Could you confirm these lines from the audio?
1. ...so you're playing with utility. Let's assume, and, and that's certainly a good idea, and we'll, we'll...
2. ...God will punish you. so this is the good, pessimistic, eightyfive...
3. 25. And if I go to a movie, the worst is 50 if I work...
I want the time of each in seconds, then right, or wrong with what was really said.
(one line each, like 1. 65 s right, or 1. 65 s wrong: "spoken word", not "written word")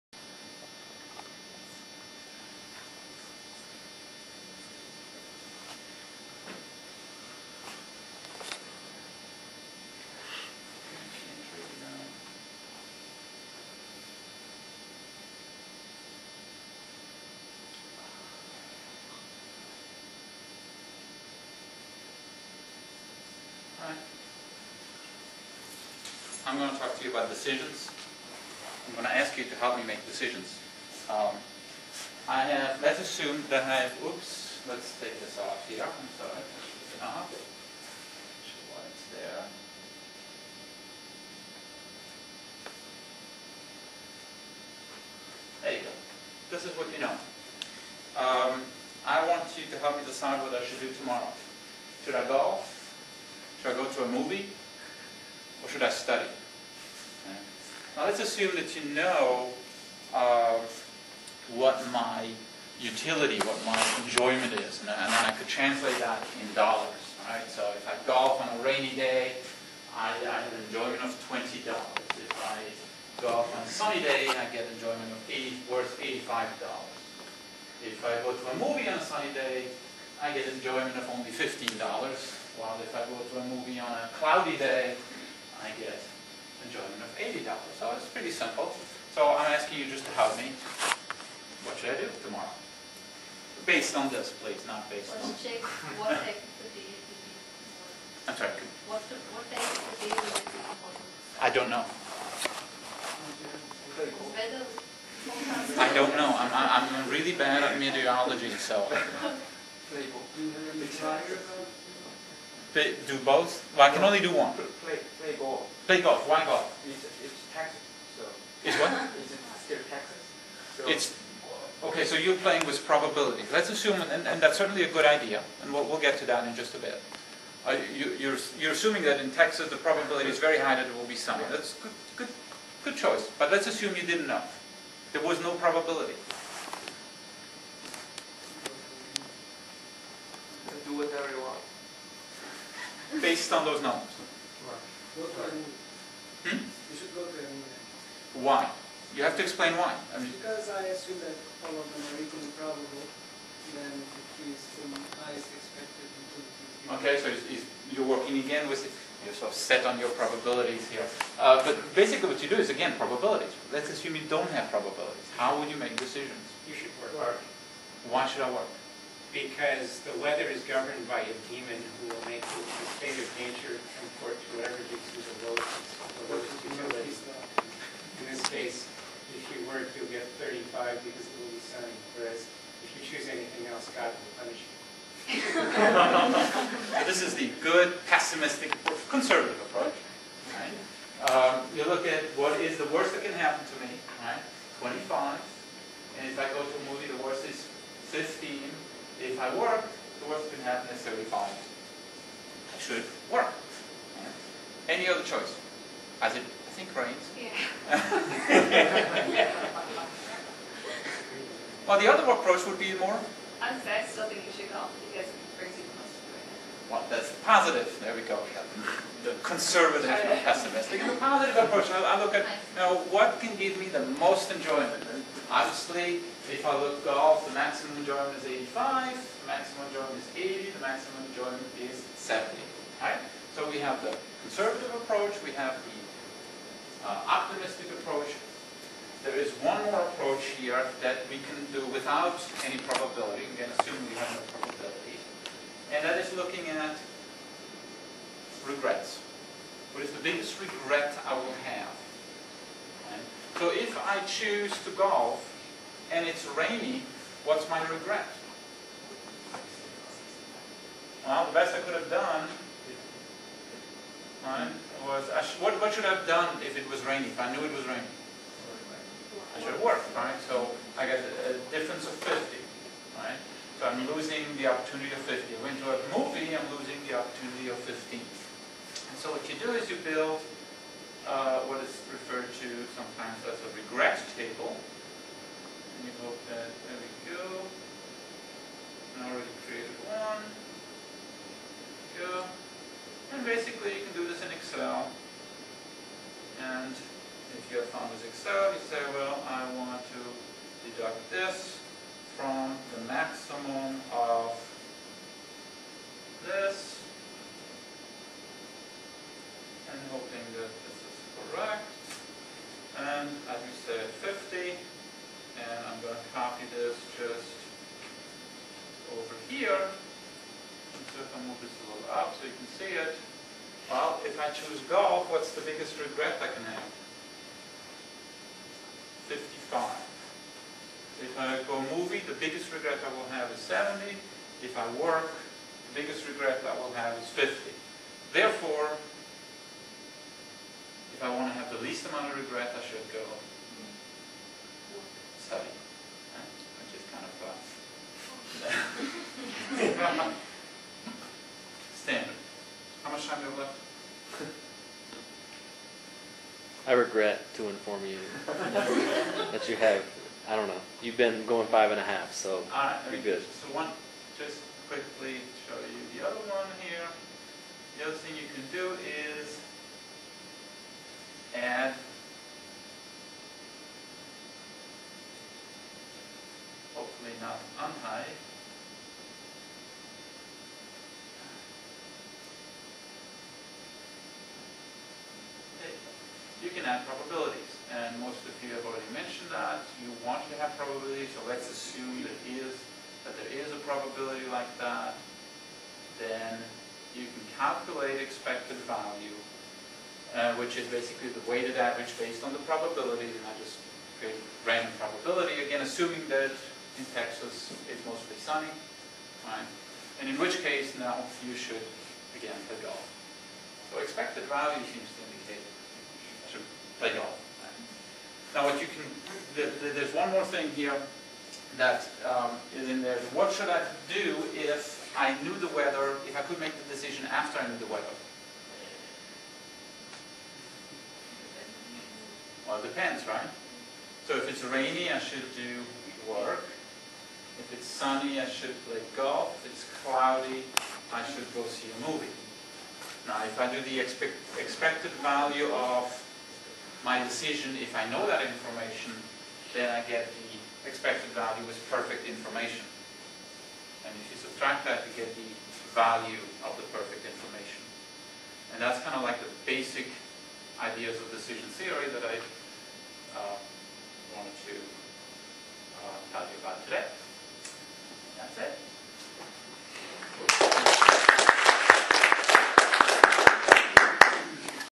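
1. 122 s wrong: "probability", not "utility"
2. 183 s wrong: "conservative", not "eightyfive"
3. 194 s right.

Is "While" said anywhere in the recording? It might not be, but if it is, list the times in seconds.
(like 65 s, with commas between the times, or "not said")
82 s.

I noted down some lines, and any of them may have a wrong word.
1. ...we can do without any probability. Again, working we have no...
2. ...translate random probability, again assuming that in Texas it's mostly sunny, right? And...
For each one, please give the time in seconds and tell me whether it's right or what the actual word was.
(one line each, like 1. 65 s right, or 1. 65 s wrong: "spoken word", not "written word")
1. 241 s wrong: "assuming", not "working"
2. 404 s wrong: "create", not "translate".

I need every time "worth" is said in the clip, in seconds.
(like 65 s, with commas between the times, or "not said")
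75 s.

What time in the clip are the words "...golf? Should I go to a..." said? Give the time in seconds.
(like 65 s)
52 s.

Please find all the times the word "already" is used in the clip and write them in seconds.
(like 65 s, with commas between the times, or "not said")
289 s, 388 s.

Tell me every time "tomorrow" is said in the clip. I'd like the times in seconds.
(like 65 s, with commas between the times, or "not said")
50 s, 92 s.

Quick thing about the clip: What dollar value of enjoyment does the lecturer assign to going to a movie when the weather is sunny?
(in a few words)
$15.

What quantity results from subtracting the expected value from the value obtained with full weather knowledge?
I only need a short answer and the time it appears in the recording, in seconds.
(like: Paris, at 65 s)
value of the perfect information, at 455 s.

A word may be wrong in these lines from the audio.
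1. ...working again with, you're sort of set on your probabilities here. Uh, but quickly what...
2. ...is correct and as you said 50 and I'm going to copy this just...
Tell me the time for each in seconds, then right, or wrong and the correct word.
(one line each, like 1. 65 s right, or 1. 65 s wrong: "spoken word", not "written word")
1. 158 s wrong: "basically", not "quickly"
2. 310 s right.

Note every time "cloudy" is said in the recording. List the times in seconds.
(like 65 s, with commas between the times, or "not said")
84 s, 440 s.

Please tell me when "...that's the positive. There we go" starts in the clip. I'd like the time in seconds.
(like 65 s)
217 s.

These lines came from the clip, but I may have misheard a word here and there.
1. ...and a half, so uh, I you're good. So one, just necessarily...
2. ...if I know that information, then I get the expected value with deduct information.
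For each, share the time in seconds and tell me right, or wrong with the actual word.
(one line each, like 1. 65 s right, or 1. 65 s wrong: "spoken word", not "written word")
1. 361 s wrong: "quickly", not "necessarily"
2. 447 s wrong: "perfect", not "deduct".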